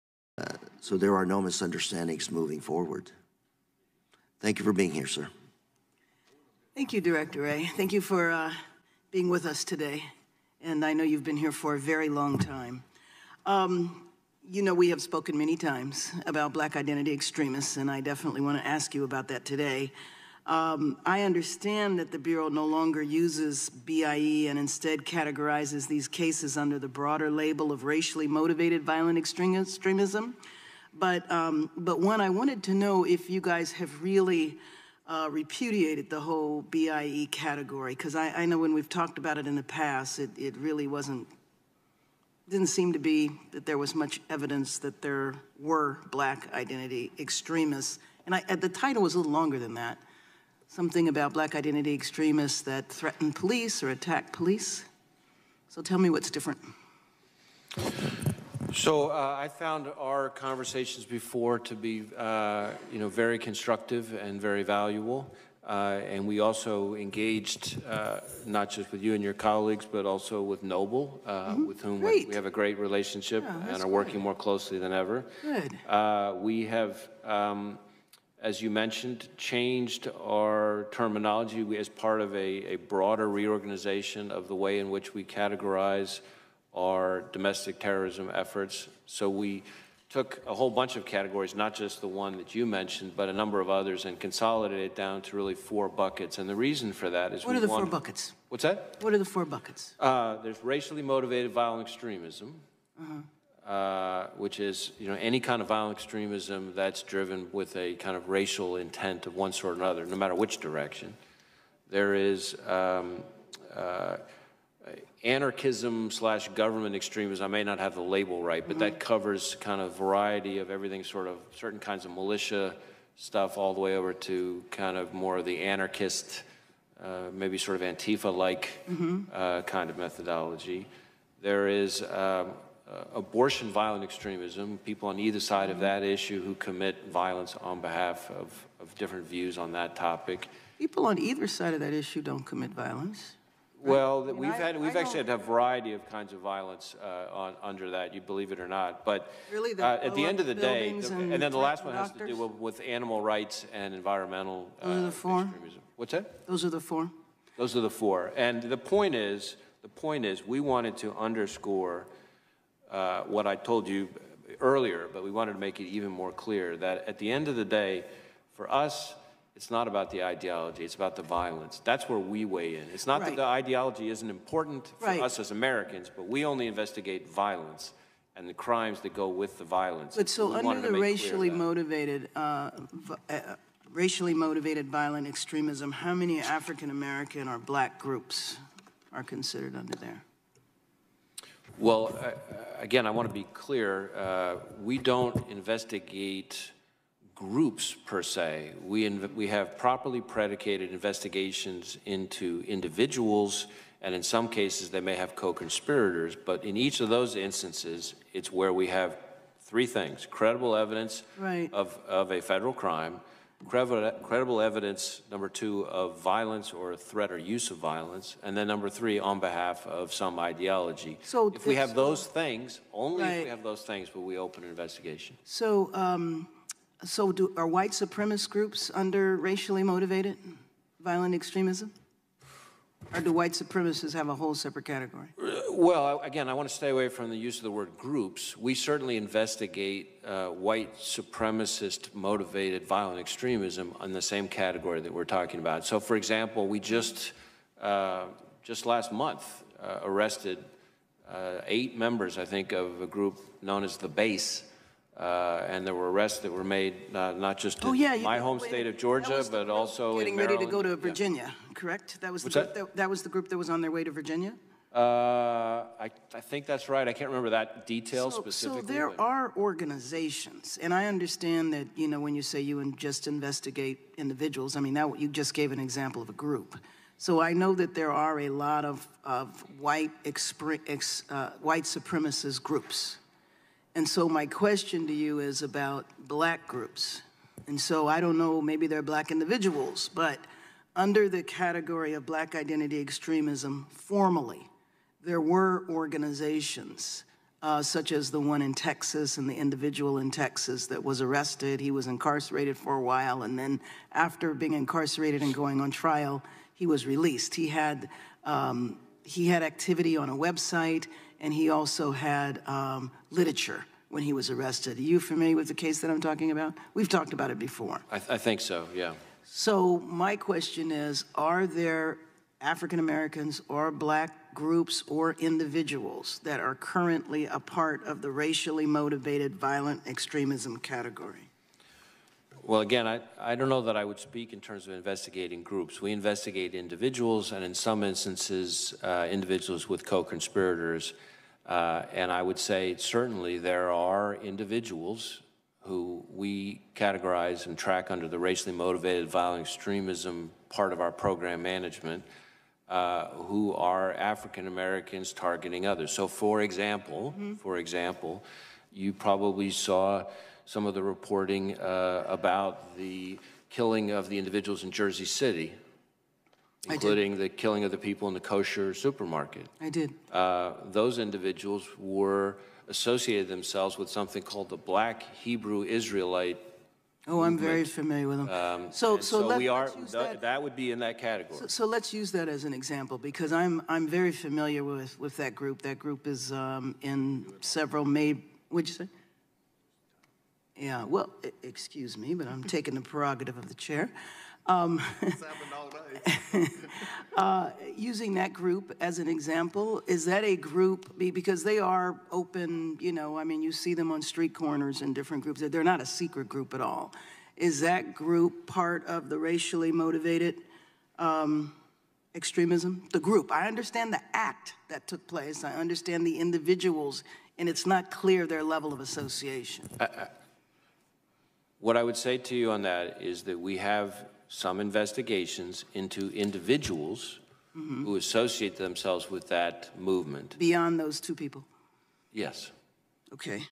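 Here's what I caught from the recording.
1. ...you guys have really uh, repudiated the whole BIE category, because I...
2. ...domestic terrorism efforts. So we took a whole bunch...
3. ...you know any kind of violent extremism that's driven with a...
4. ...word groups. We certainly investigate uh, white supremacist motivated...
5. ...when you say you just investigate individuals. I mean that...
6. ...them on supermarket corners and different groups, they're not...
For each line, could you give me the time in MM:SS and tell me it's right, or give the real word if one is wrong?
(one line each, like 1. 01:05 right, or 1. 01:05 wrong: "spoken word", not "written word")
1. 00:33 right
2. 01:27 right
3. 01:44 right
4. 03:57 right
5. 04:32 right
6. 06:43 wrong: "street", not "supermarket".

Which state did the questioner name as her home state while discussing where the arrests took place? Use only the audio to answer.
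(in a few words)
Georgia.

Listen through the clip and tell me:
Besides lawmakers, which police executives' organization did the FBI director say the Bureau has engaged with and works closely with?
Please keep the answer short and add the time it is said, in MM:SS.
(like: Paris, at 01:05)
NOBLE, at 01:10.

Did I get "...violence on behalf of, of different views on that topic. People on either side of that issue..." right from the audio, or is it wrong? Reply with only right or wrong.
right.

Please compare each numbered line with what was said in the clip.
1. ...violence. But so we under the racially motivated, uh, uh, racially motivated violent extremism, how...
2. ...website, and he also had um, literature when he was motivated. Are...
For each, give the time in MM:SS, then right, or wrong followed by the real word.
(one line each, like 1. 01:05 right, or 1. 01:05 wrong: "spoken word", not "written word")
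1. 02:59 right
2. 05:10 wrong: "arrested", not "motivated".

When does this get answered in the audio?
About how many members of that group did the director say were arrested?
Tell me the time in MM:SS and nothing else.
04:11.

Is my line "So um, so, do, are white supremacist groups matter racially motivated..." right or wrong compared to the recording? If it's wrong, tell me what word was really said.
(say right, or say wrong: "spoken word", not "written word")
wrong: "under", not "matter".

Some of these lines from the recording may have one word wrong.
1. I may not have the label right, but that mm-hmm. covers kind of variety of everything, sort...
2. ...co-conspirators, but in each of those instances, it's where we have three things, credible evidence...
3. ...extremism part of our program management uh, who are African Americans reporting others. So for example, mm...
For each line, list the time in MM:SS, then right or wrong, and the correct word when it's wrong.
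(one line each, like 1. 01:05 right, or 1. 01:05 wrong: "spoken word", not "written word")
1. 01:57 right
2. 03:25 right
3. 05:49 wrong: "targeting", not "reporting".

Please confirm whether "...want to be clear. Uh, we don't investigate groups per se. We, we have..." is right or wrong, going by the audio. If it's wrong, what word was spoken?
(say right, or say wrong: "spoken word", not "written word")
right.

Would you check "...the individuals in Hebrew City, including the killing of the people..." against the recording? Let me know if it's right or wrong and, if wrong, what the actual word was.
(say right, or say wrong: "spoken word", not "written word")
wrong: "Jersey", not "Hebrew".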